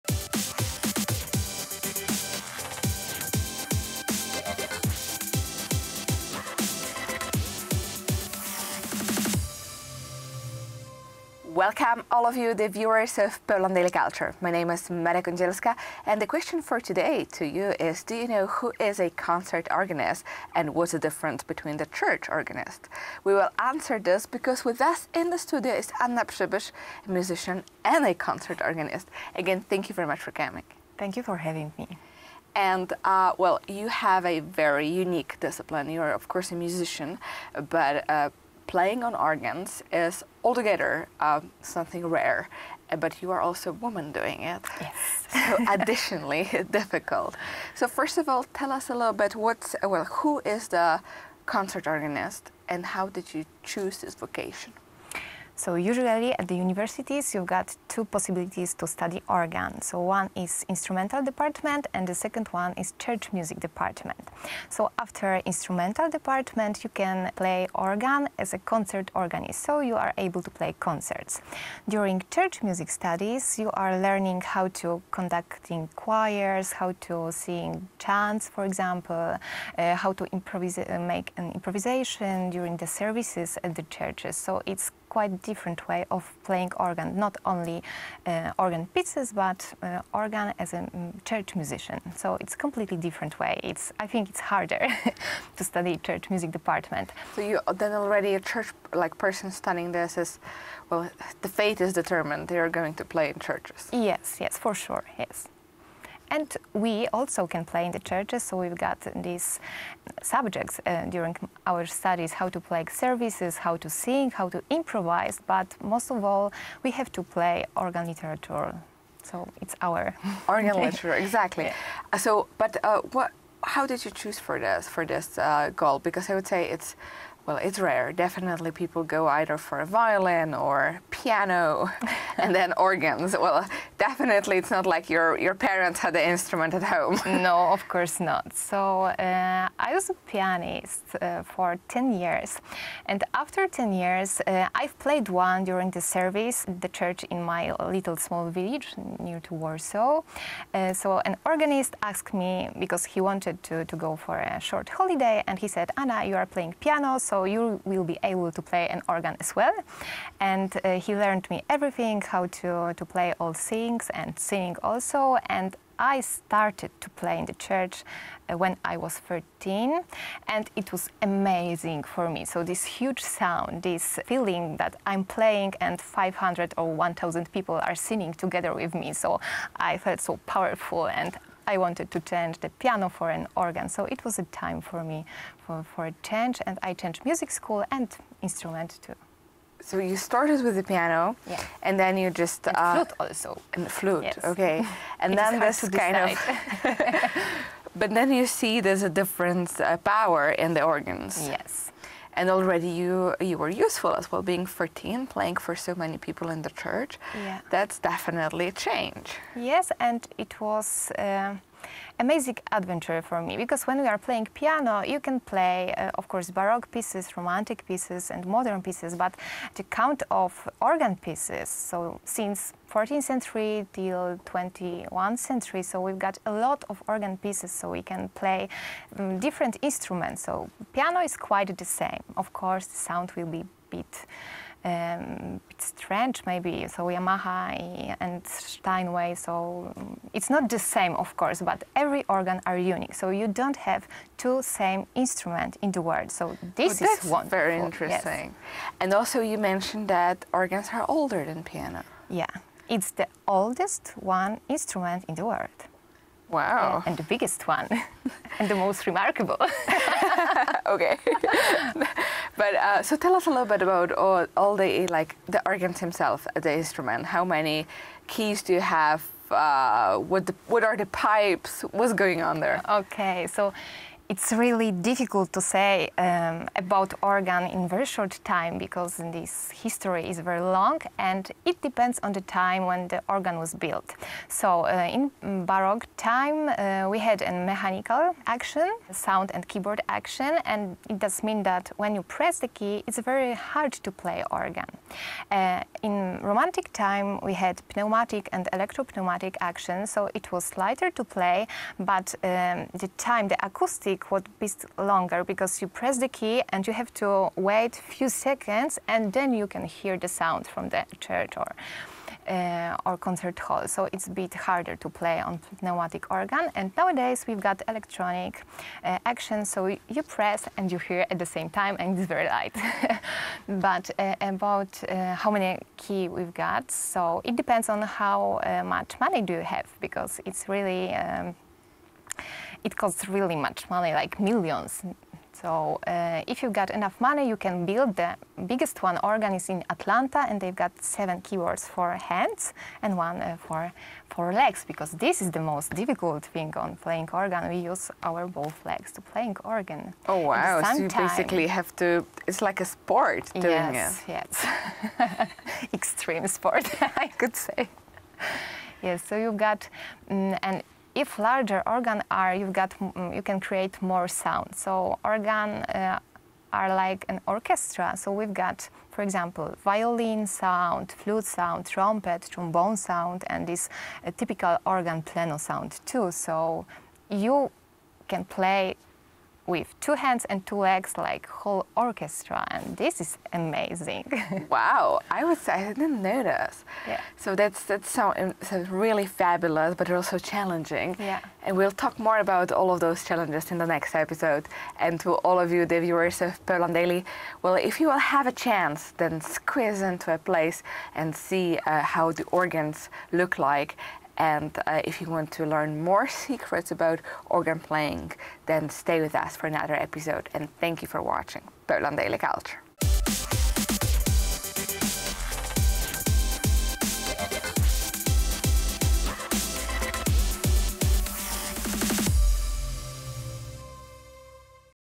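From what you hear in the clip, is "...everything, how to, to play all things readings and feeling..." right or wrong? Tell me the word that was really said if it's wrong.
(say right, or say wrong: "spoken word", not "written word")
wrong: "singing", not "feeling".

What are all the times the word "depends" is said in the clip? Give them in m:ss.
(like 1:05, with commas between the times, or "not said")
4:41, 5:27.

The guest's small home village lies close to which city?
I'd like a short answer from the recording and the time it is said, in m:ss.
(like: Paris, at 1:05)
Warsaw, at 2:29.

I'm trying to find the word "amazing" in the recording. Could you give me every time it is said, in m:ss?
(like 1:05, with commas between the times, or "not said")
2:51, 3:32, 6:23.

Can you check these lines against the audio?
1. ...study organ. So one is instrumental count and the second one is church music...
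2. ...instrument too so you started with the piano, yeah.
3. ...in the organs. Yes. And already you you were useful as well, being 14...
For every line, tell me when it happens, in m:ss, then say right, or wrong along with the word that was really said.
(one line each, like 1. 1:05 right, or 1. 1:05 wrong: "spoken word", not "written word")
1. 0:58 wrong: "department", not "count"
2. 3:08 right
3. 3:20 right.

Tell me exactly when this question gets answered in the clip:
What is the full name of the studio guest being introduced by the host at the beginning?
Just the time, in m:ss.
0:26.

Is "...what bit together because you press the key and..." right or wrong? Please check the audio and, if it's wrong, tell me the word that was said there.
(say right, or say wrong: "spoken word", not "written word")
wrong: "longer", not "together".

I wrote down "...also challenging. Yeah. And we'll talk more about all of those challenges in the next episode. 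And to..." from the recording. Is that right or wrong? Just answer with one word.
right.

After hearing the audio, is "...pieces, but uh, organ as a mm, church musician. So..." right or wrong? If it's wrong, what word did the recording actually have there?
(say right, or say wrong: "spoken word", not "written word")
right.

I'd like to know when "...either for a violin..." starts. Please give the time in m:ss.
2:09.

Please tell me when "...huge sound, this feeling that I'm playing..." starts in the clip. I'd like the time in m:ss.
2:52.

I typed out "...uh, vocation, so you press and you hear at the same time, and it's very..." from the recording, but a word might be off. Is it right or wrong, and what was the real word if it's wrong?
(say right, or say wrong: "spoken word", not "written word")
wrong: "action", not "vocation".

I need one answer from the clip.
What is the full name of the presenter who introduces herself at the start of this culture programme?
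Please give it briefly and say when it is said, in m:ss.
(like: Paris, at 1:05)
Maria Kądzielska, at 0:14.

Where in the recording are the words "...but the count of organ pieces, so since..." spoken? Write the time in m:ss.
3:39.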